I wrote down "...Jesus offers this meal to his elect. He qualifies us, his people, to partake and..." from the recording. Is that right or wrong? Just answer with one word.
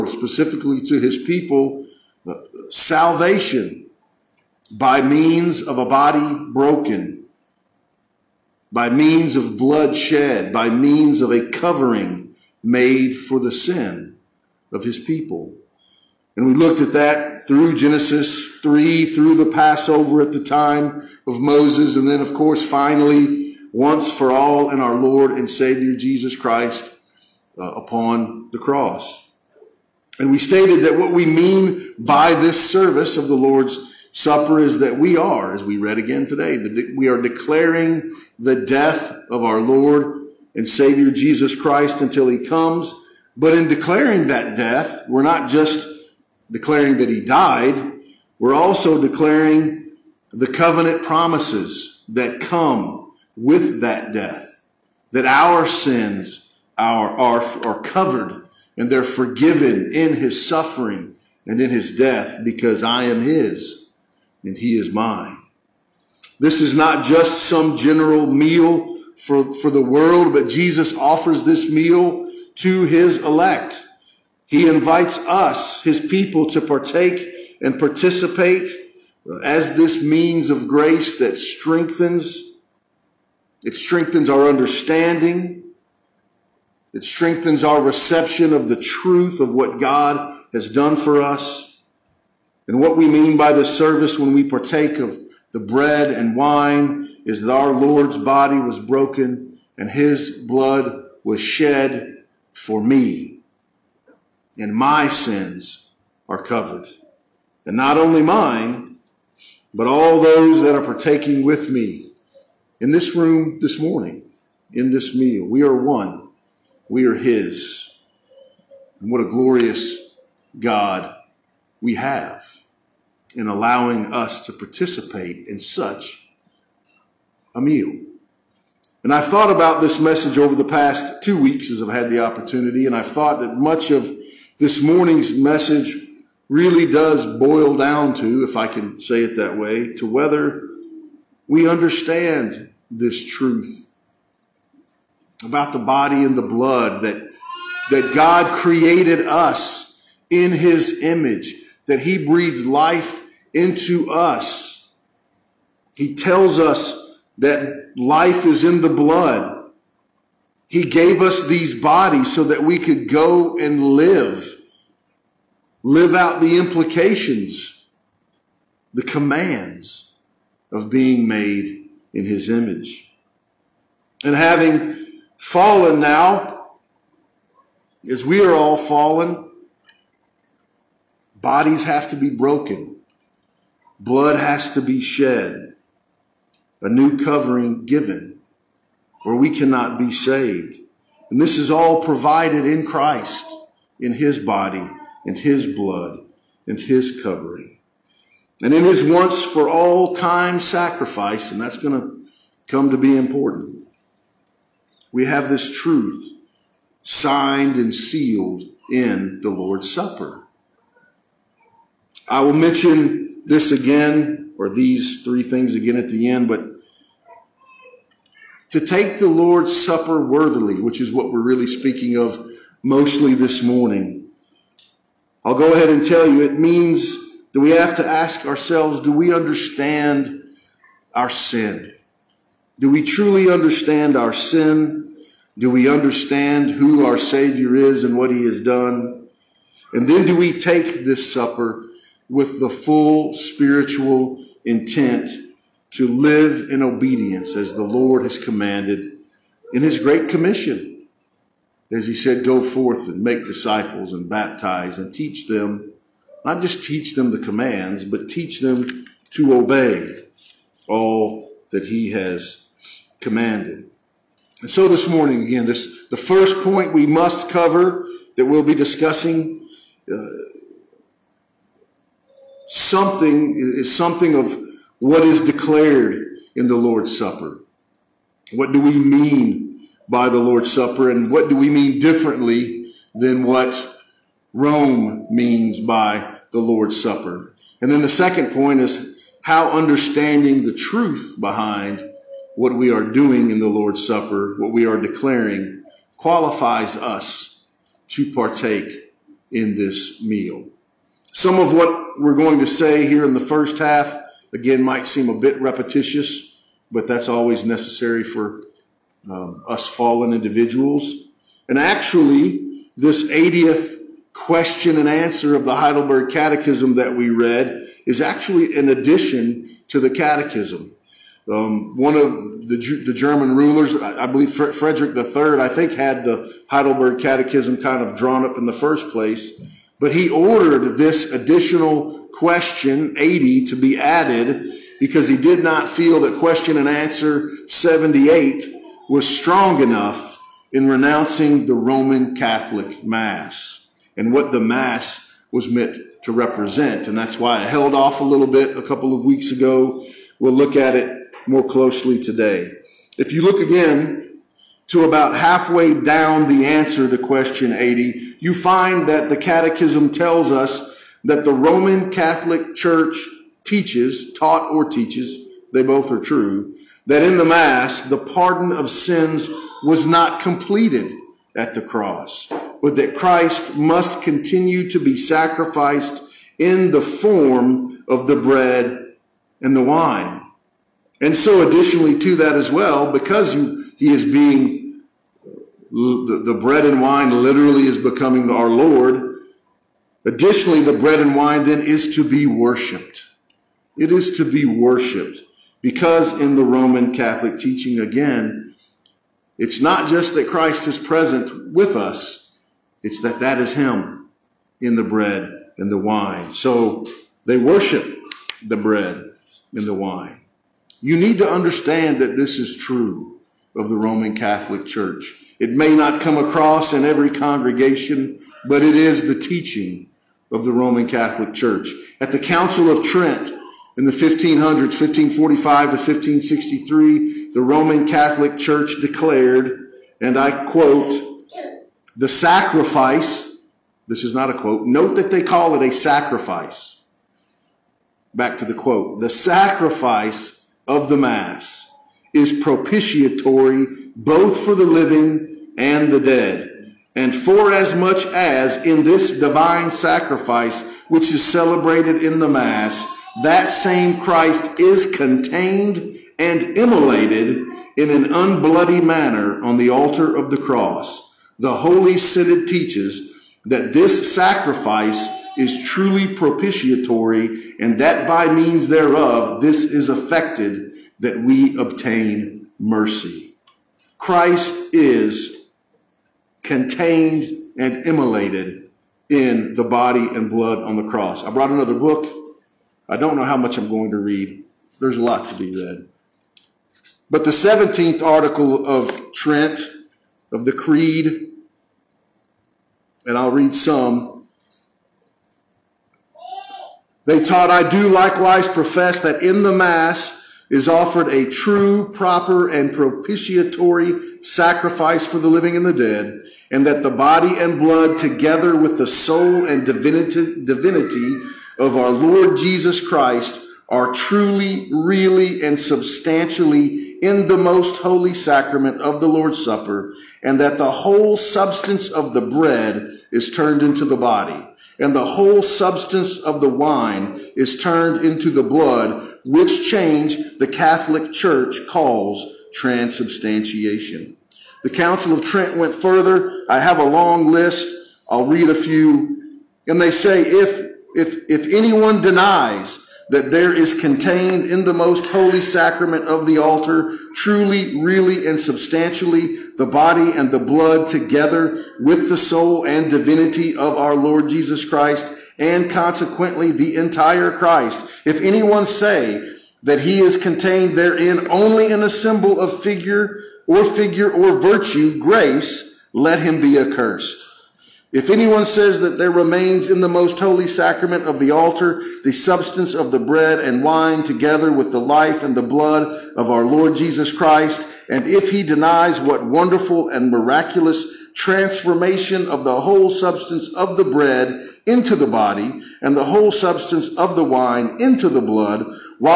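wrong.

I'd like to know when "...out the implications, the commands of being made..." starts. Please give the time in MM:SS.
02:46.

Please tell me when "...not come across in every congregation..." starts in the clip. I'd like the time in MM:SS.
06:55.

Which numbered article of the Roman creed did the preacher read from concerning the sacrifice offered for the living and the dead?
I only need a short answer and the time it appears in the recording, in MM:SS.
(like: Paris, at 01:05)
17th, at 08:07.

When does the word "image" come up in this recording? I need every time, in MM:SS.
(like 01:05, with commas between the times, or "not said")
02:31, 02:52.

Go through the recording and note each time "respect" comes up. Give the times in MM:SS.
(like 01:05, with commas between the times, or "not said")
not said.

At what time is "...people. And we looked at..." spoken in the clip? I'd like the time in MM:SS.
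00:14.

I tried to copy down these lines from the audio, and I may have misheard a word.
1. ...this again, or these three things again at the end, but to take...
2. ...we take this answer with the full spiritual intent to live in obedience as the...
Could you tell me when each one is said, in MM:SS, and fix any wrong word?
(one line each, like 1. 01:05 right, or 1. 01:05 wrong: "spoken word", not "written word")
1. 03:33 right
2. 04:00 wrong: "supper", not "answer".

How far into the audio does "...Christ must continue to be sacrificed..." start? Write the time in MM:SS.
06:13.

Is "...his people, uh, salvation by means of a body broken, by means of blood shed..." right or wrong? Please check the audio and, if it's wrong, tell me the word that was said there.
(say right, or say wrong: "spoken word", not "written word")
right.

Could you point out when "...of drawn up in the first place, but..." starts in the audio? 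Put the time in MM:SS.
05:28.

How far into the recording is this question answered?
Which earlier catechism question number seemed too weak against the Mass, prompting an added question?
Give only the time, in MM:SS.
05:37.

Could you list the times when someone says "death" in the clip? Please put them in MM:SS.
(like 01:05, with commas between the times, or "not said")
00:38, 00:44, 00:54, 01:01.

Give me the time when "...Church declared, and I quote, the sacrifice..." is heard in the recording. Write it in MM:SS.
07:08.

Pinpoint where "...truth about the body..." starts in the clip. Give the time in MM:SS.
02:23.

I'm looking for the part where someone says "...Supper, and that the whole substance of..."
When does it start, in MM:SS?
08:39.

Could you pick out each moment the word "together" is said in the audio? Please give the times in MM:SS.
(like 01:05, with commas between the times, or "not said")
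08:28, 09:11, 09:34.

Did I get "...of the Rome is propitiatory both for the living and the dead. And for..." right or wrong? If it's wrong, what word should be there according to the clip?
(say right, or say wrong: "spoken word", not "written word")
wrong: "Mass", not "Rome".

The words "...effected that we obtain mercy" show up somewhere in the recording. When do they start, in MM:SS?
07:50.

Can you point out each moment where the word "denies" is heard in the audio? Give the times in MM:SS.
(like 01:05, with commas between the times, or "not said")
09:02, 09:38.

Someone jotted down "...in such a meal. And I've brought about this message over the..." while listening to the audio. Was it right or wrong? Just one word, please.
wrong.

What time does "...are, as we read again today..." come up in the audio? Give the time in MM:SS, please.
00:35.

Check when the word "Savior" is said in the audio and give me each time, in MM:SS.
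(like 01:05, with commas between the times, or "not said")
00:25, 00:40, 03:57.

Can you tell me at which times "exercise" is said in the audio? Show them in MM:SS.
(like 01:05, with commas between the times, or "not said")
not said.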